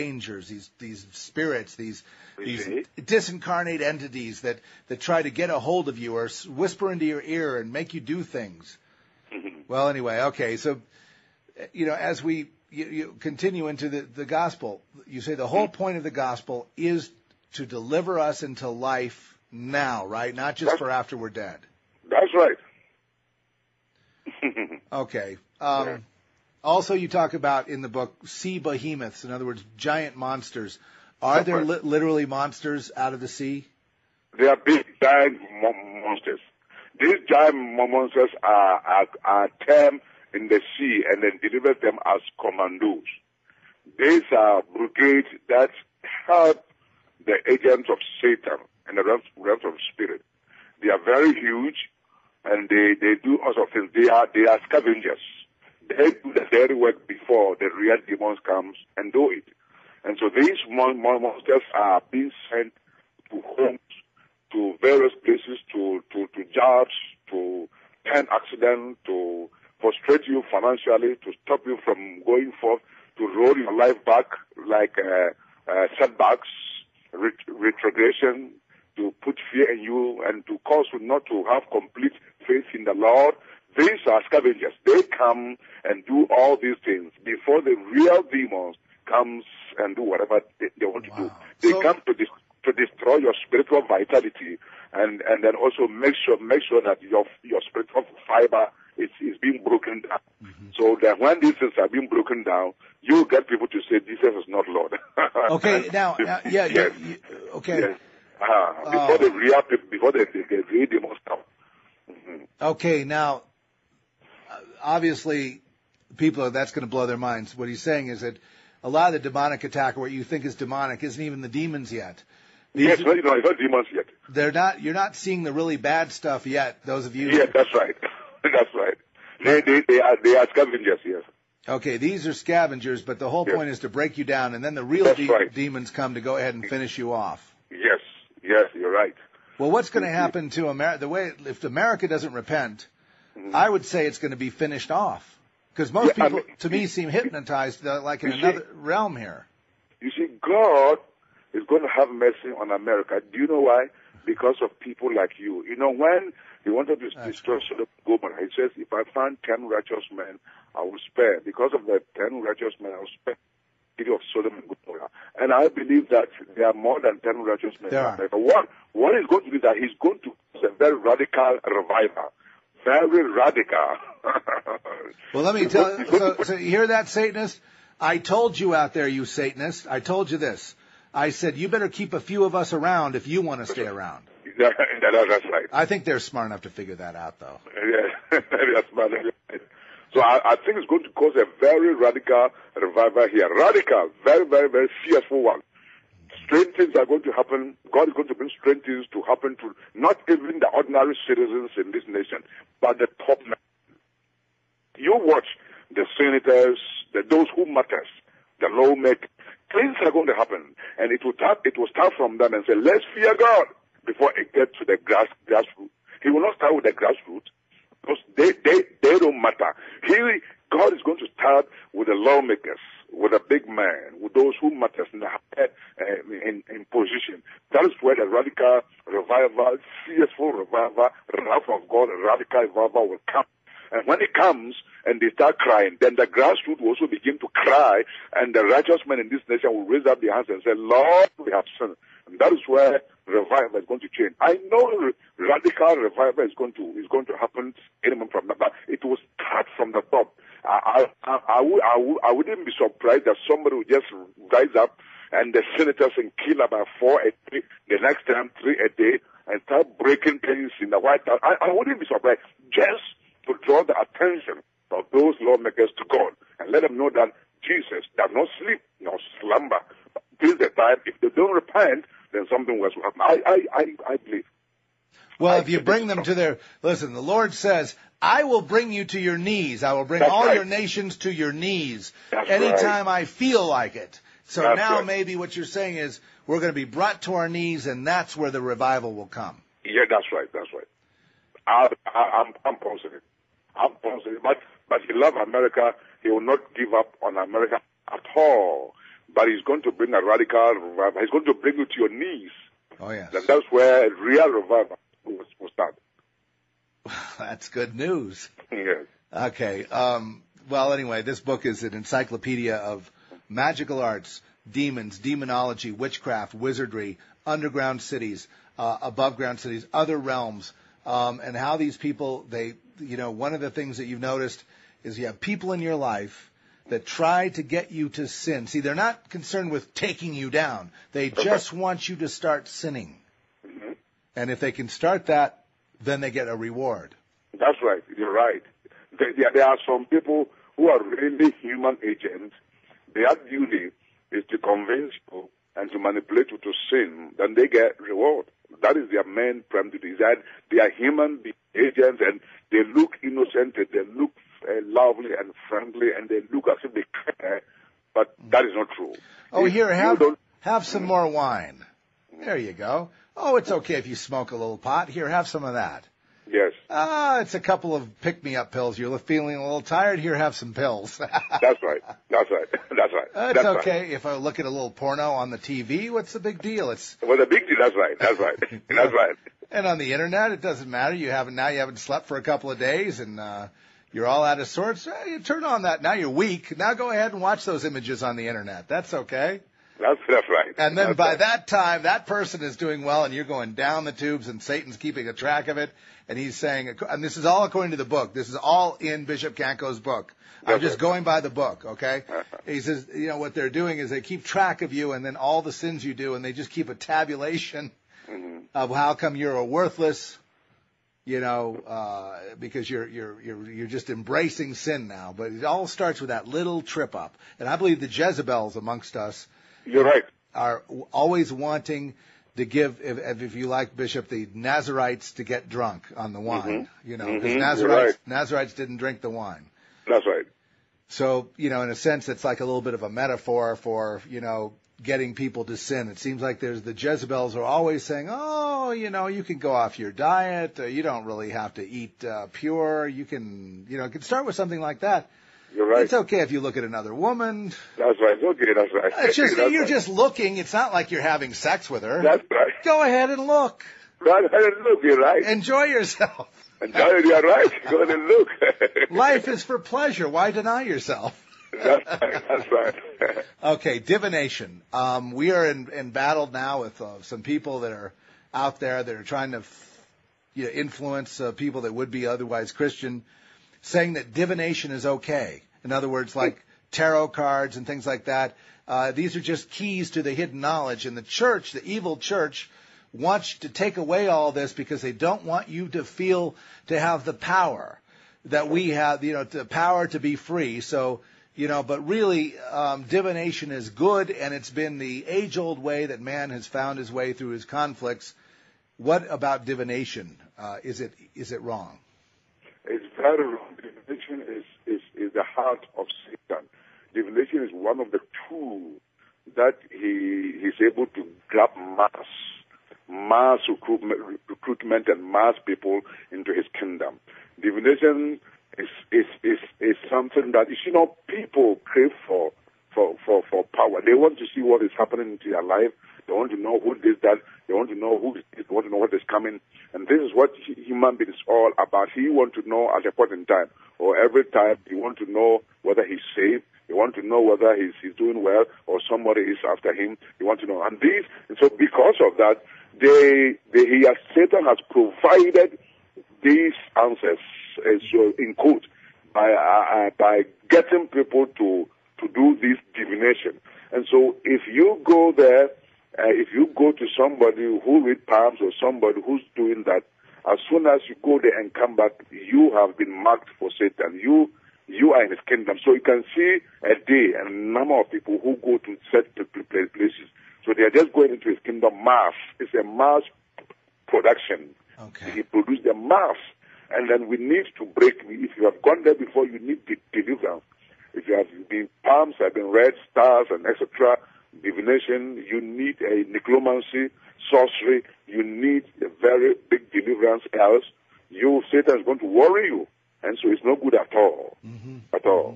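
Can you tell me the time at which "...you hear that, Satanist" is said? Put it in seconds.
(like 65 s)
176 s.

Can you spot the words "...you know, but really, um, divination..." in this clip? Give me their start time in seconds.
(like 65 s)
491 s.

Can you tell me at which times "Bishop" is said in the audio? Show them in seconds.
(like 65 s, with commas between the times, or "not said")
399 s, 423 s.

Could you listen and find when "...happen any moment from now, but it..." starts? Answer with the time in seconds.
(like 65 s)
247 s.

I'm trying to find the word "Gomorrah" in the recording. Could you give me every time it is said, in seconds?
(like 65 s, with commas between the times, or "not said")
158 s, 164 s.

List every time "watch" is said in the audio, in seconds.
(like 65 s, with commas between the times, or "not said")
205 s, 387 s.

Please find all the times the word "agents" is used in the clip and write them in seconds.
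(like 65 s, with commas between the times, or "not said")
47 s, 342 s, 351 s.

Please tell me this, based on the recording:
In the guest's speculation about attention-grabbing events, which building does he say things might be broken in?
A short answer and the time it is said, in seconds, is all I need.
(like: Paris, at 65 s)
The White House, at 260 s.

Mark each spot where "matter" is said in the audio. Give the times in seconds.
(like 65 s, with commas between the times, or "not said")
207 s, 219 s, 224 s, 380 s.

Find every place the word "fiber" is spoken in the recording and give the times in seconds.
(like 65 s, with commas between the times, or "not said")
98 s.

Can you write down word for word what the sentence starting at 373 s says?
Uh, it's that's okay if I look at a little porno on the TV.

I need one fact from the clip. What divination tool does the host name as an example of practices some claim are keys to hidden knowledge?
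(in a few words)
Tarot cards.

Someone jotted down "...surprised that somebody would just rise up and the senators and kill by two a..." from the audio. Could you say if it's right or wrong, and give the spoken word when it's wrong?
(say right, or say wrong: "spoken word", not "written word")
wrong: "four", not "two".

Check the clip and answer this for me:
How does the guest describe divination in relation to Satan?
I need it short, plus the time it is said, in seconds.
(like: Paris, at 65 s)
The heart of Satan, at 505 s.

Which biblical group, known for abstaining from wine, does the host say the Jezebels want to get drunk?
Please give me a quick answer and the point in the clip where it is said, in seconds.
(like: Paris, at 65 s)
The Nazarites, at 424 s.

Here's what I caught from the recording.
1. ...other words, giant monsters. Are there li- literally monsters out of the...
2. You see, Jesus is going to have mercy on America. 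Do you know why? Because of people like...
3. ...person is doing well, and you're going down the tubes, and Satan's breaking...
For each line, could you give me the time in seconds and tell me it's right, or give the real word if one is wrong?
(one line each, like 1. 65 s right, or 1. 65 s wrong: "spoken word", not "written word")
1. 29 s right
2. 150 s wrong: "God", not "Jesus"
3. 392 s wrong: "keeping", not "breaking".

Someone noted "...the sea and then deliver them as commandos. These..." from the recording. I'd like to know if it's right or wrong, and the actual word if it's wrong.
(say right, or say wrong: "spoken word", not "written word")
right.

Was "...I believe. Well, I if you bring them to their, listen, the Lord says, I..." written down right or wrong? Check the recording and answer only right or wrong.
right.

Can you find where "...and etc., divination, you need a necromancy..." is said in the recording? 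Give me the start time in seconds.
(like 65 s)
583 s.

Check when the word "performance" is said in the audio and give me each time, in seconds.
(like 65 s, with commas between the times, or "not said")
not said.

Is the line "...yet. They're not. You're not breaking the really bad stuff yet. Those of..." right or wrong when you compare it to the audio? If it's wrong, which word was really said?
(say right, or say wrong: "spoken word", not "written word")
wrong: "seeing", not "breaking".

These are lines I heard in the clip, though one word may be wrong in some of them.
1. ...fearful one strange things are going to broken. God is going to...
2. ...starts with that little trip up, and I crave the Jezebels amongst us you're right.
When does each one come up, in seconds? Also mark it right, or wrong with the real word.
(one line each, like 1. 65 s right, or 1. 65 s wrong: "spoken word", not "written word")
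1. 195 s wrong: "happen", not "broken"
2. 415 s wrong: "believe", not "crave".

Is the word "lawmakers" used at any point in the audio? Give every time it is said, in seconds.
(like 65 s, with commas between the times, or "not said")
208 s, 222 s, 265 s.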